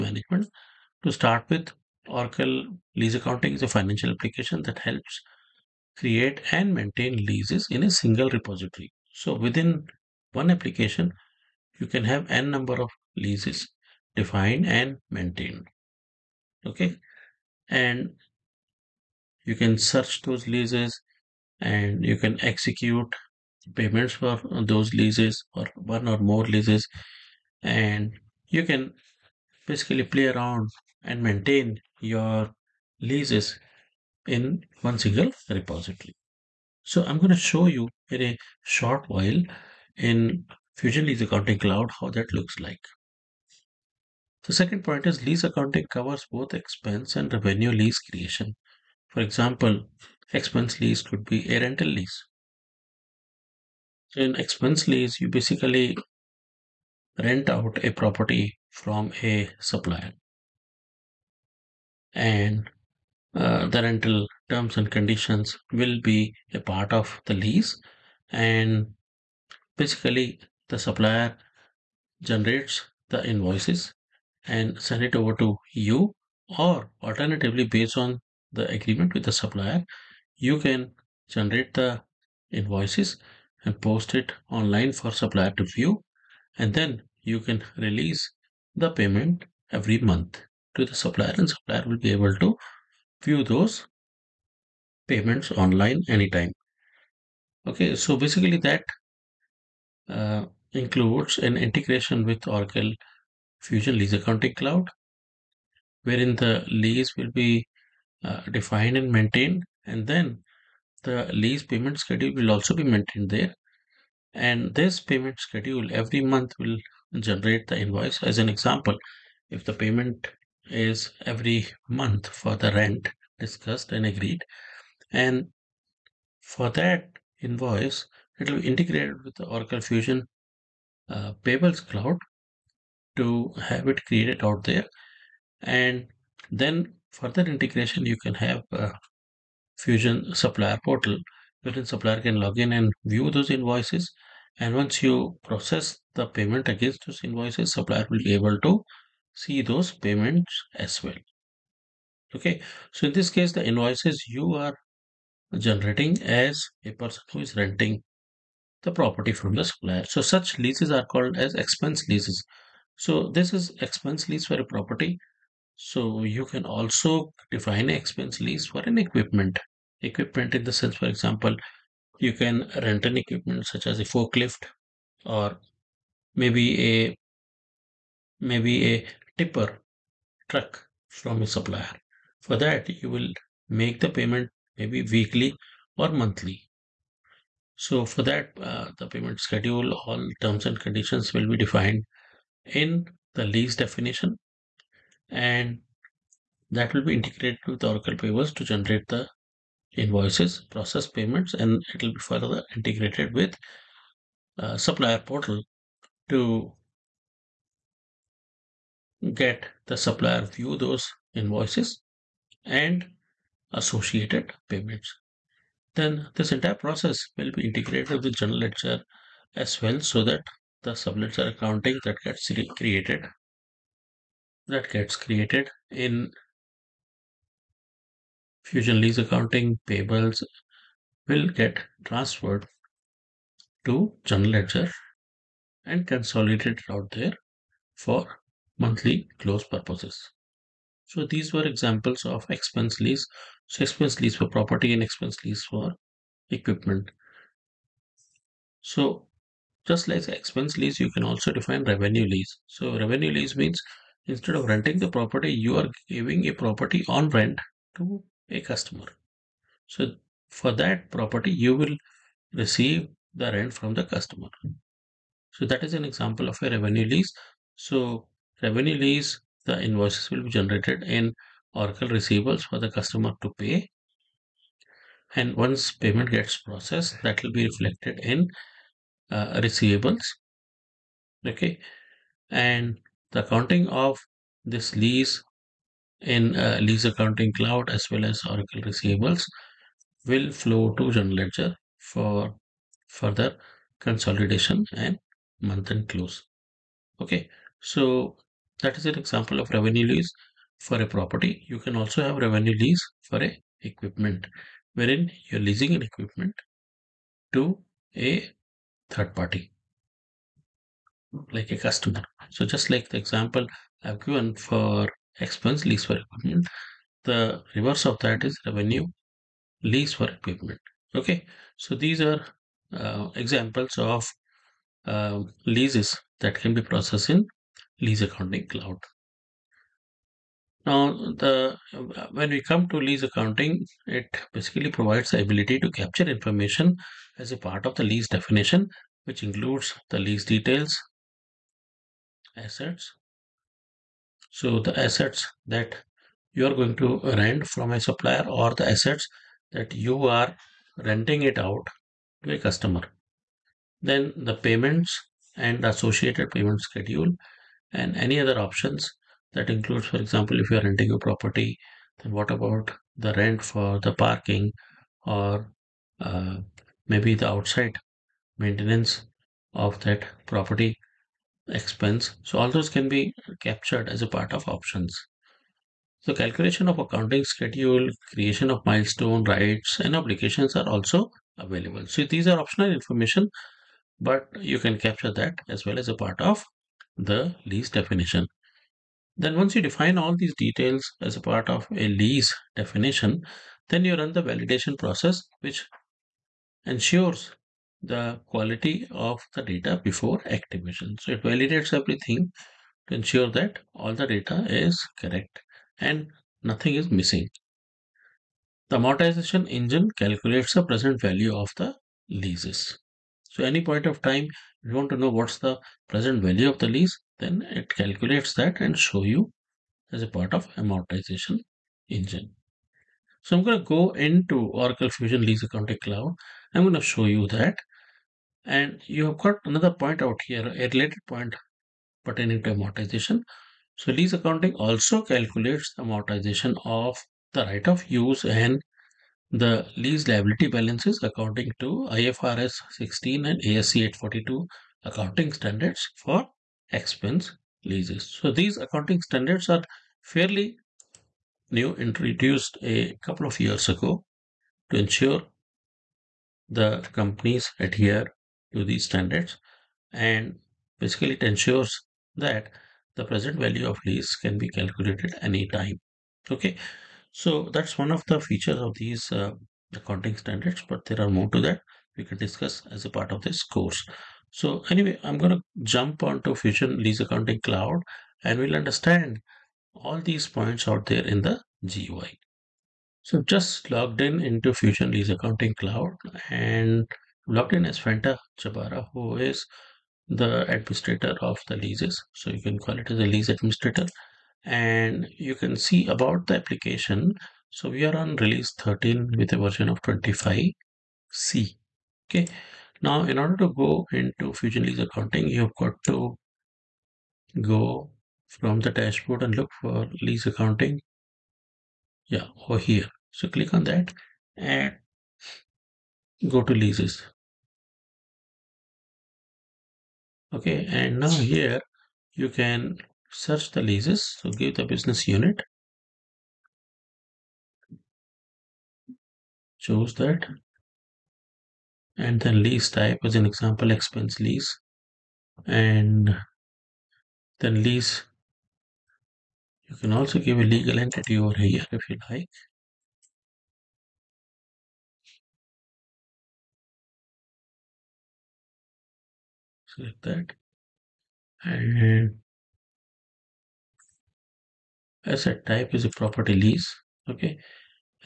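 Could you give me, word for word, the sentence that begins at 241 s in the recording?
So these were examples of expense lease.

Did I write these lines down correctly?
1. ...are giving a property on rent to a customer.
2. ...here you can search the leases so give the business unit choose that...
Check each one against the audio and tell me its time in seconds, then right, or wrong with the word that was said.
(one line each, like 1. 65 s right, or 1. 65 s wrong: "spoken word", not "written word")
1. 255 s right
2. 521 s right.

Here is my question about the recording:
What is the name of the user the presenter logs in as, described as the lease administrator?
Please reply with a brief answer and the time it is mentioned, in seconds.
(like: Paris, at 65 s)
Fanta Chabara, at 487 s.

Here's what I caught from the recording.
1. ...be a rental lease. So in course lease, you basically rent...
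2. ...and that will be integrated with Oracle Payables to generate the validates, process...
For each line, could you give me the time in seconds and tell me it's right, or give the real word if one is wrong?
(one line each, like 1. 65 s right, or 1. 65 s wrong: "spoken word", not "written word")
1. 51 s wrong: "expense", not "course"
2. 195 s wrong: "invoices", not "validates".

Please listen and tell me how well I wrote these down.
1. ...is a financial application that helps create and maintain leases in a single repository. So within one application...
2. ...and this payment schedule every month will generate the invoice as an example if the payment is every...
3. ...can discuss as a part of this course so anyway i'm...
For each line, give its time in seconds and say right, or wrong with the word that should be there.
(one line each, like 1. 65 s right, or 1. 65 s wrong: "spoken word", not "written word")
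1. 3 s right
2. 114 s right
3. 472 s right.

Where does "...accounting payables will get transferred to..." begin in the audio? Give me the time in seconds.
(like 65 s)
229 s.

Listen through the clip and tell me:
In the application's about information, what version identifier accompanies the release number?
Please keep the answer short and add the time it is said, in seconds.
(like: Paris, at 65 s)
25C, at 500 s.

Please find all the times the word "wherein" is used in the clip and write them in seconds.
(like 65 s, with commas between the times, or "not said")
106 s, 141 s, 304 s.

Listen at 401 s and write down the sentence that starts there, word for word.
So it validates everything to ensure that all the data is correct and nothing is missing.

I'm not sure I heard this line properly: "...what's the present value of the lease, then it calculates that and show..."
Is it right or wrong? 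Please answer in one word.
right.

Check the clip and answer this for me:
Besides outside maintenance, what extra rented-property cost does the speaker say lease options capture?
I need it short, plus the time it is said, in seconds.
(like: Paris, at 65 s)
parking, at 364 s.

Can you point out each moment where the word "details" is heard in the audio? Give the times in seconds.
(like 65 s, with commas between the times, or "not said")
340 s, 390 s.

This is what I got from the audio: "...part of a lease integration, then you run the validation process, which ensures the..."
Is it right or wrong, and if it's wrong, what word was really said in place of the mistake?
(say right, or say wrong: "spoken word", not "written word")
wrong: "definition", not "integration".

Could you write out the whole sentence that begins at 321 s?
Okay, so these are uh, examples of uh, leases that can be processed in lease accounting cloud.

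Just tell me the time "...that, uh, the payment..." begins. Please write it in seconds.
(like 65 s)
188 s.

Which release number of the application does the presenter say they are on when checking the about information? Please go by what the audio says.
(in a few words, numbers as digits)
13.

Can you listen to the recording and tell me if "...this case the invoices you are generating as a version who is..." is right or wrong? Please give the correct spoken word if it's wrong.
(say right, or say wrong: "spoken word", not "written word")
wrong: "person", not "version".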